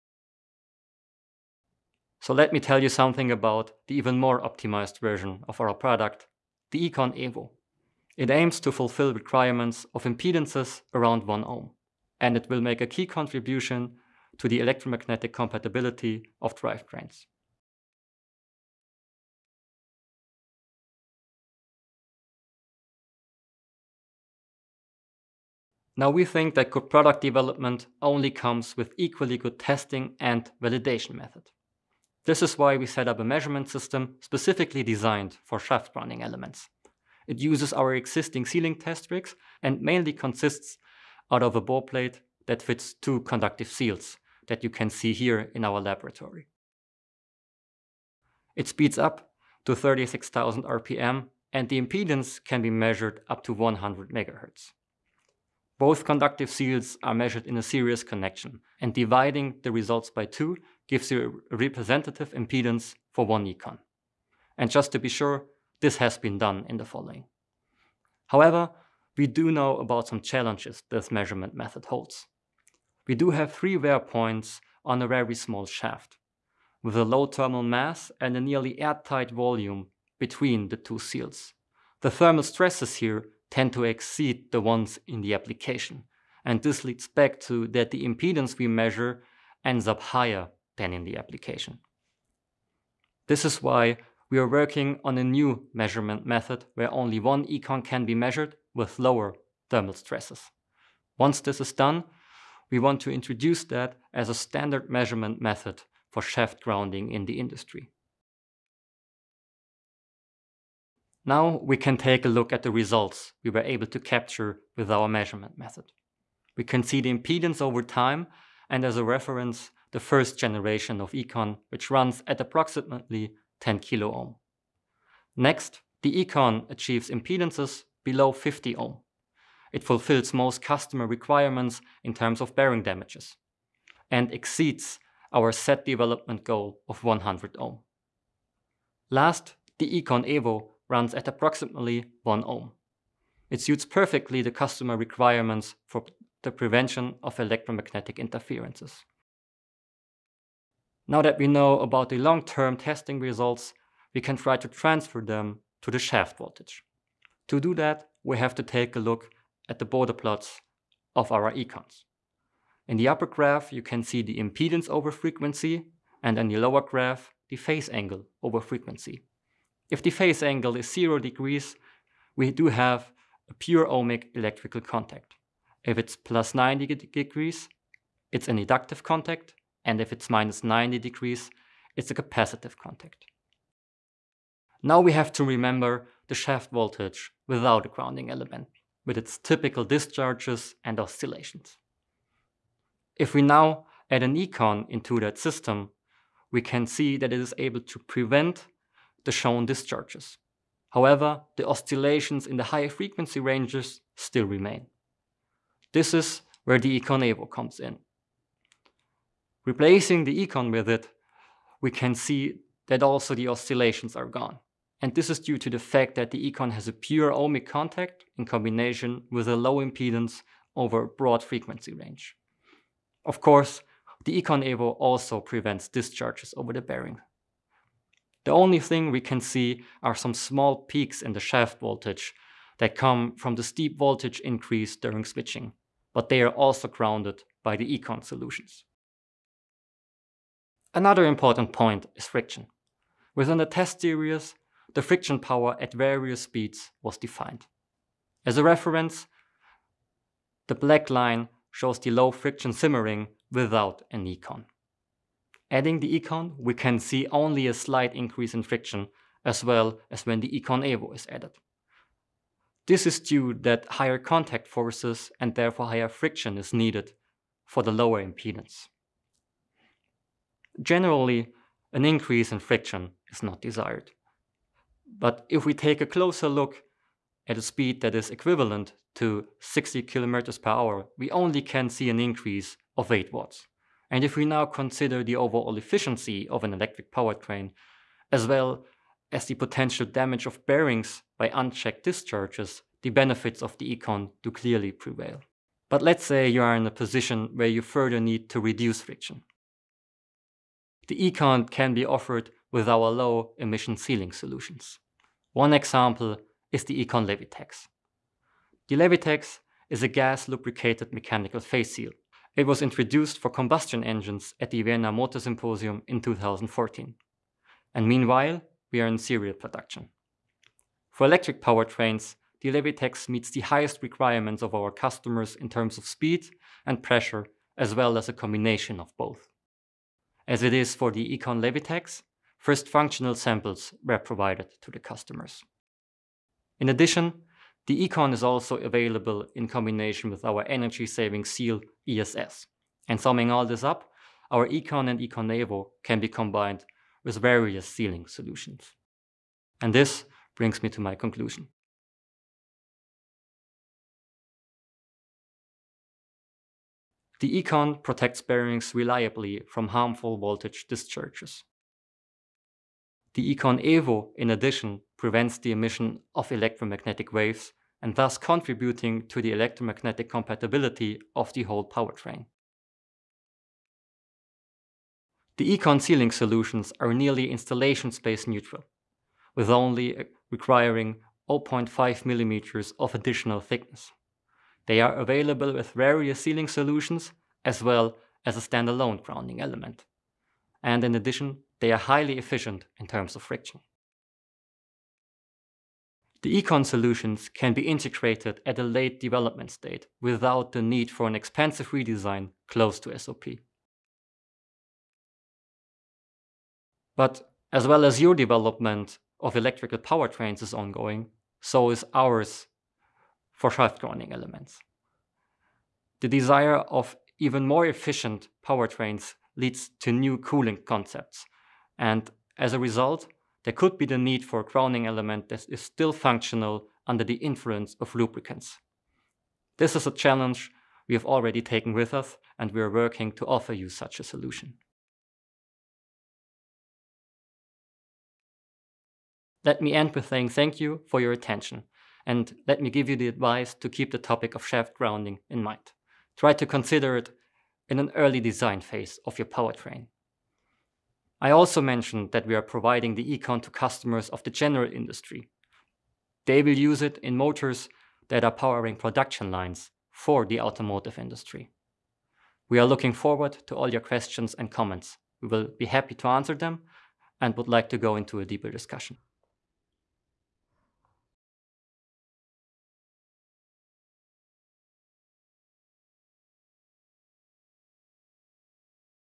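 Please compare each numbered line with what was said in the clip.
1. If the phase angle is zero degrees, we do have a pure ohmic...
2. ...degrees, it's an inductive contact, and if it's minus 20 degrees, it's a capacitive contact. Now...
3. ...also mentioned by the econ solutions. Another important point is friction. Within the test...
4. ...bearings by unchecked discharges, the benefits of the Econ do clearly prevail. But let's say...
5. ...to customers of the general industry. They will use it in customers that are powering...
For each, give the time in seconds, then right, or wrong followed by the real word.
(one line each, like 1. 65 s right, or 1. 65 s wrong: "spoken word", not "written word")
1. 169 s right
2. 176 s wrong: "90", not "20"
3. 236 s wrong: "grounded", not "mentioned"
4. 290 s right
5. 453 s wrong: "motors", not "customers".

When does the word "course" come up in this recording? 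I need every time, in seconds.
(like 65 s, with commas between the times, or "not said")
223 s.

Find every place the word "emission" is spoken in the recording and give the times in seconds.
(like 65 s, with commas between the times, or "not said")
303 s, 365 s.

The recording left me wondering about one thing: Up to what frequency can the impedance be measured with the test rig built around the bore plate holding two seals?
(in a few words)
100 MHz.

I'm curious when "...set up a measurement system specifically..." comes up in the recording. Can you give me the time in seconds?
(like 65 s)
32 s.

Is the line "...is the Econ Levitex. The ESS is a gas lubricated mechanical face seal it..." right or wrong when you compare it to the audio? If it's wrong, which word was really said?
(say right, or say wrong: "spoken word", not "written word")
wrong: "Levitex", not "ESS".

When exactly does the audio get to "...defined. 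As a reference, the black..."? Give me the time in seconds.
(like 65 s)
247 s.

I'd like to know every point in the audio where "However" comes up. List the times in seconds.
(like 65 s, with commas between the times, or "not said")
68 s, 200 s.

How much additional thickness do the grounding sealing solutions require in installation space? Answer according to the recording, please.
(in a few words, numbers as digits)
0.5 millimeters.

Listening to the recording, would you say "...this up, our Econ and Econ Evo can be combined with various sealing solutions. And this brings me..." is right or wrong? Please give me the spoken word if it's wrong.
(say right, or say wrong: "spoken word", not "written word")
right.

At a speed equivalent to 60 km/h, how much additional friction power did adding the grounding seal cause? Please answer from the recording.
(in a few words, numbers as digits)
8 watts.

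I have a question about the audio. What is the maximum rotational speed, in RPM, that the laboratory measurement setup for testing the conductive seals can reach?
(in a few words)
36,000 RPM.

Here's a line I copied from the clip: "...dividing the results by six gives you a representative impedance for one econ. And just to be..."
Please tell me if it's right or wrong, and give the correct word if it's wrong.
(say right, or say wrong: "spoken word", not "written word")
wrong: "two", not "six".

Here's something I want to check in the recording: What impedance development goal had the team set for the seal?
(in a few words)
100 ohm.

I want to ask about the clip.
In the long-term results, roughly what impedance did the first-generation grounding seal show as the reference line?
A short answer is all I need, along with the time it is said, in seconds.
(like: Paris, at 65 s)
10 kilo ohm, at 123 s.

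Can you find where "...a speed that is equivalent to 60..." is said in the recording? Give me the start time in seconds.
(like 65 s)
277 s.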